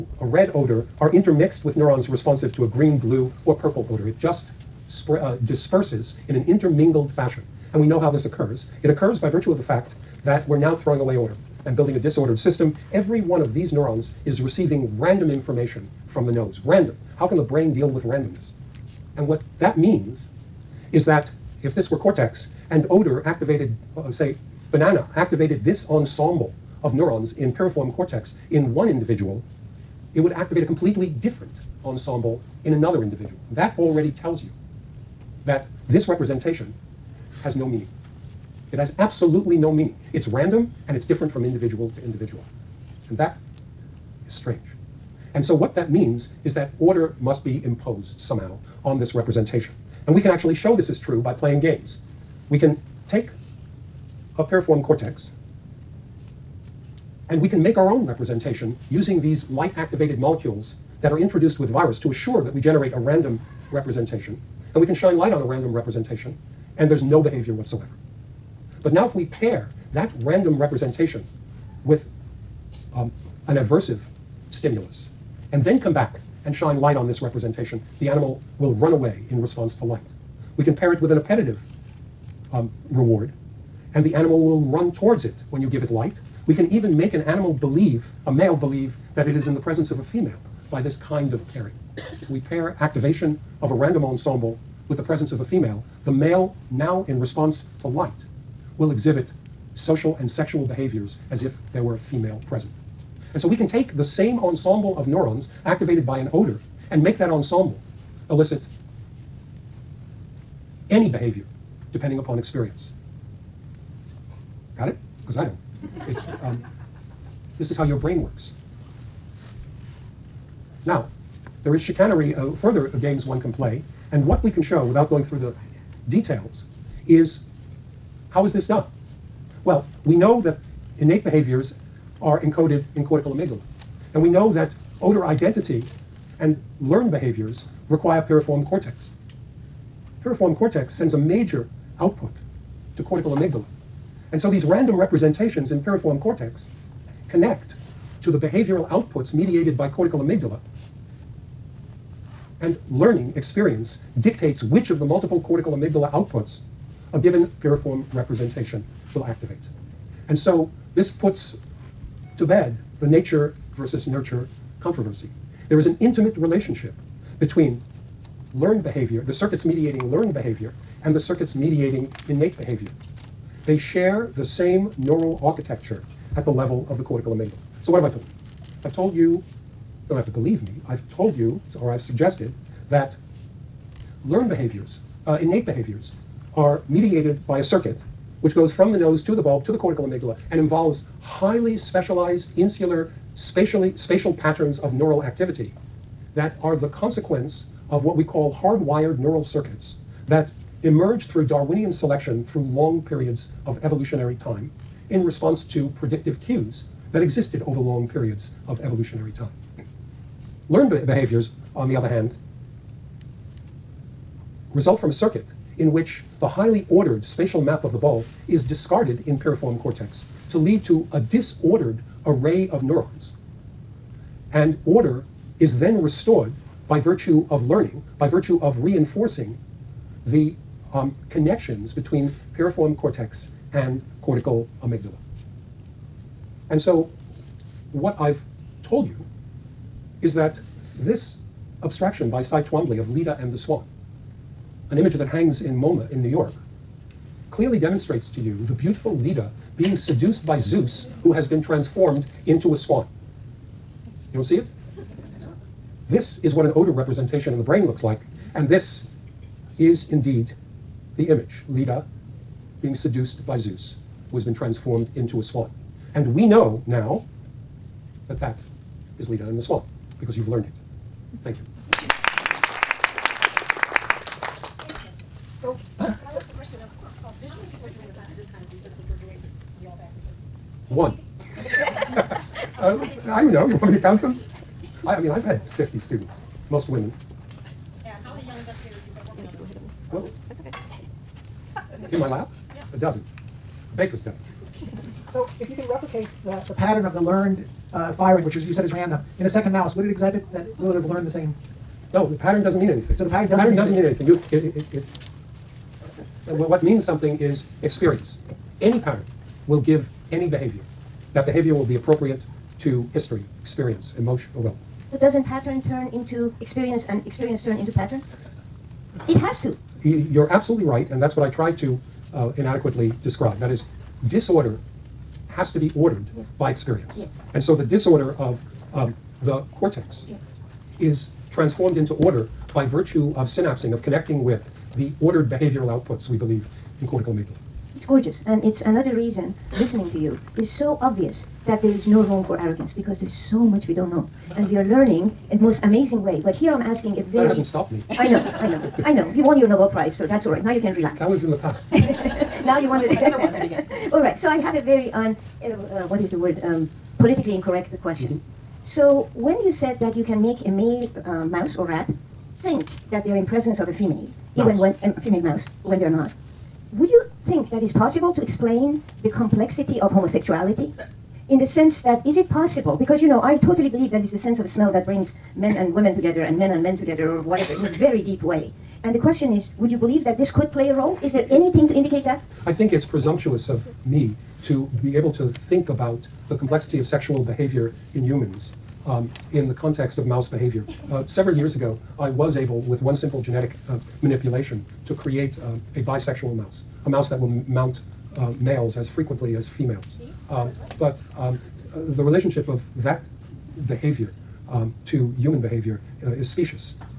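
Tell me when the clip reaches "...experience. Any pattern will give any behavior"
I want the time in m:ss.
5:07.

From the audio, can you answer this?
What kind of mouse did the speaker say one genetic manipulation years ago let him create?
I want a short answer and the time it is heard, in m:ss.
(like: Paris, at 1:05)
A bisexual mouse, at 6:35.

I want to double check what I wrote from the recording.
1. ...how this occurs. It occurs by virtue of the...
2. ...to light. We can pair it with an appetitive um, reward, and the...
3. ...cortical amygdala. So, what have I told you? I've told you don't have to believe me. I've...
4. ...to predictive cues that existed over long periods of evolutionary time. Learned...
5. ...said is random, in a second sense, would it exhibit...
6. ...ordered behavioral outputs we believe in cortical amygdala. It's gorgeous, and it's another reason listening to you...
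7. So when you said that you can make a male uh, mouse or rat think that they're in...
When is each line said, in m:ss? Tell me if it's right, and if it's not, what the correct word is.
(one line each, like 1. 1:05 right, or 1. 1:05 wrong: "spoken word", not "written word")
1. 0:07 right
2. 1:19 right
3. 2:57 right
4. 3:25 right
5. 4:58 wrong: "mouse", not "sense"
6. 5:35 right
7. 5:58 right.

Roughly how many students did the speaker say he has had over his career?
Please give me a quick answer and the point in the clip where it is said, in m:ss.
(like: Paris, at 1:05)
50, at 4:45.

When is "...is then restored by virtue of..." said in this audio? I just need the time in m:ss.
3:45.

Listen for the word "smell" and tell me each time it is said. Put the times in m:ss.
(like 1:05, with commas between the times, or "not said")
6:14.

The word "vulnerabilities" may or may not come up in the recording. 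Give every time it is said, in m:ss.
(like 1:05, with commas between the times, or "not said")
not said.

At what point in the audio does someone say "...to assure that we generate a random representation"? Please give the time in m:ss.
1:02.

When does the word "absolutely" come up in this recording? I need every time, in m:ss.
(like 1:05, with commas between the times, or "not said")
0:38, 5:20.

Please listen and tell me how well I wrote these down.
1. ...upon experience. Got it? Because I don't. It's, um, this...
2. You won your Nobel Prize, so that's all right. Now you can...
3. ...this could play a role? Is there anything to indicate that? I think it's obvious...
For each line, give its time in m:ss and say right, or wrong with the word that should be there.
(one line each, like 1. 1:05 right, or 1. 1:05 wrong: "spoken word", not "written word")
1. 1:52 right
2. 5:49 right
3. 6:20 wrong: "presumptuous", not "obvious".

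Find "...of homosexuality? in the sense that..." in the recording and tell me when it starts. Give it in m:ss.
6:10.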